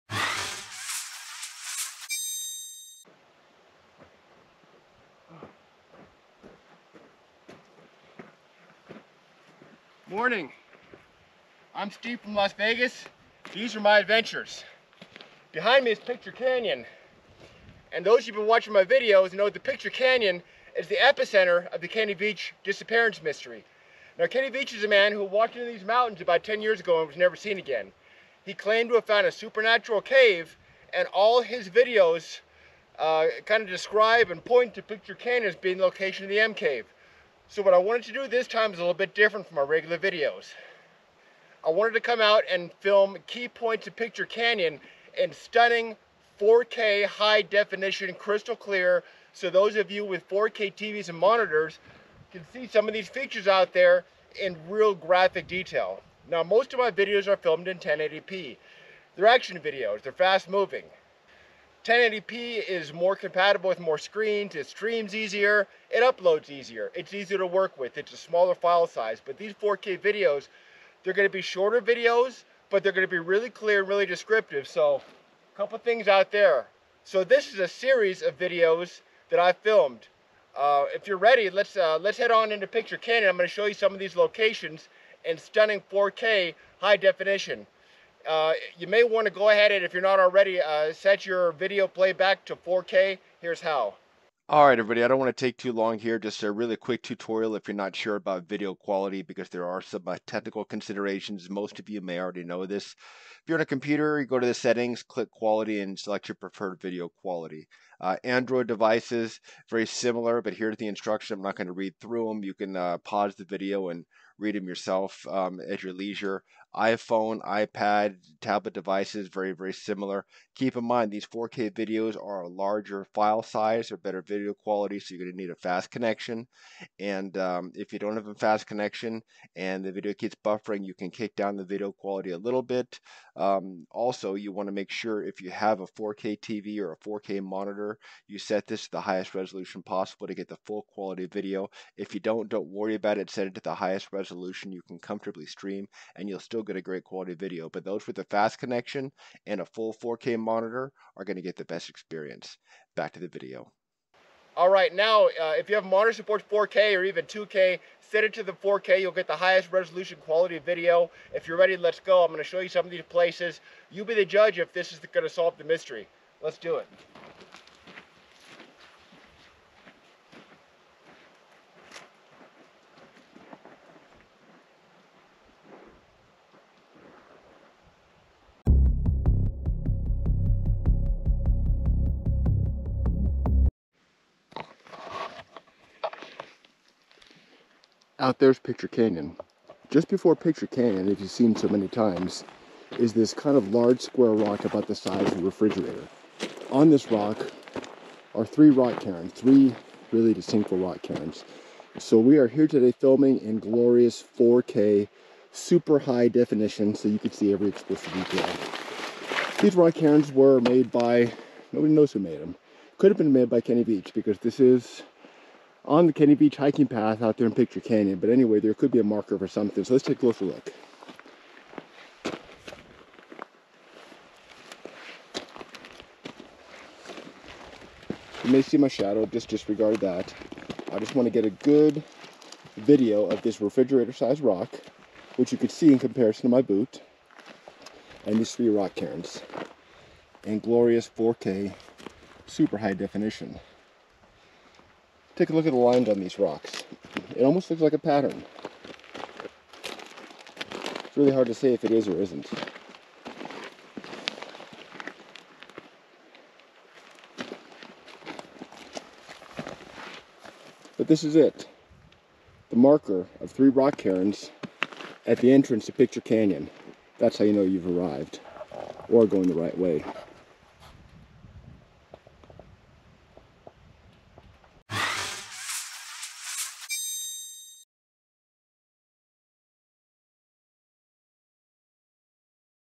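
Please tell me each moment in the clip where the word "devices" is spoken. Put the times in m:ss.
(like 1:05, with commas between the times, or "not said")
1:48, 1:58.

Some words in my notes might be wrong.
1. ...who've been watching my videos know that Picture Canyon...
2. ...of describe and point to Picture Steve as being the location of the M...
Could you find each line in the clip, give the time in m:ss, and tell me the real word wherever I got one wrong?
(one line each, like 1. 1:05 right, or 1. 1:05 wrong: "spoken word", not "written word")
1. 0:18 right
2. 0:33 wrong: "Canyon", not "Steve".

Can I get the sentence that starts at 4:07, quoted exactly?
It almost looks like a pattern.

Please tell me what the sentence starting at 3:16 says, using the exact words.
On this rock are three rock cairns, three really distinct rock cairns.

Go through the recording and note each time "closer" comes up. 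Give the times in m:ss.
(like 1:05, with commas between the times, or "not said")
3:40.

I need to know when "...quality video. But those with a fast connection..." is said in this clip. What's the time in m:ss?
2:27.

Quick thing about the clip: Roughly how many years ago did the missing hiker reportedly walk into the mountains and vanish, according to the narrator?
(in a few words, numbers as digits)
10 years.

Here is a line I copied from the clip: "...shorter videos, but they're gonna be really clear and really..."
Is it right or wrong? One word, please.
right.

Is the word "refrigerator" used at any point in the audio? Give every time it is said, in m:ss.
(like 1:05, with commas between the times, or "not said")
3:15, 3:53.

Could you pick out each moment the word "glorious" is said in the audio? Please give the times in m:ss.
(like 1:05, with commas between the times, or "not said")
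3:23, 4:00.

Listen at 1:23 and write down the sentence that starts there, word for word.
I'm gonna show you some of these locations in stunning 4K high definition.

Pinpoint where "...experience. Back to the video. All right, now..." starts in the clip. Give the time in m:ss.
2:31.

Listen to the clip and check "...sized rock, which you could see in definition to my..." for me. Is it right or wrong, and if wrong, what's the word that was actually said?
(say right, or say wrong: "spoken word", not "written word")
wrong: "comparison", not "definition".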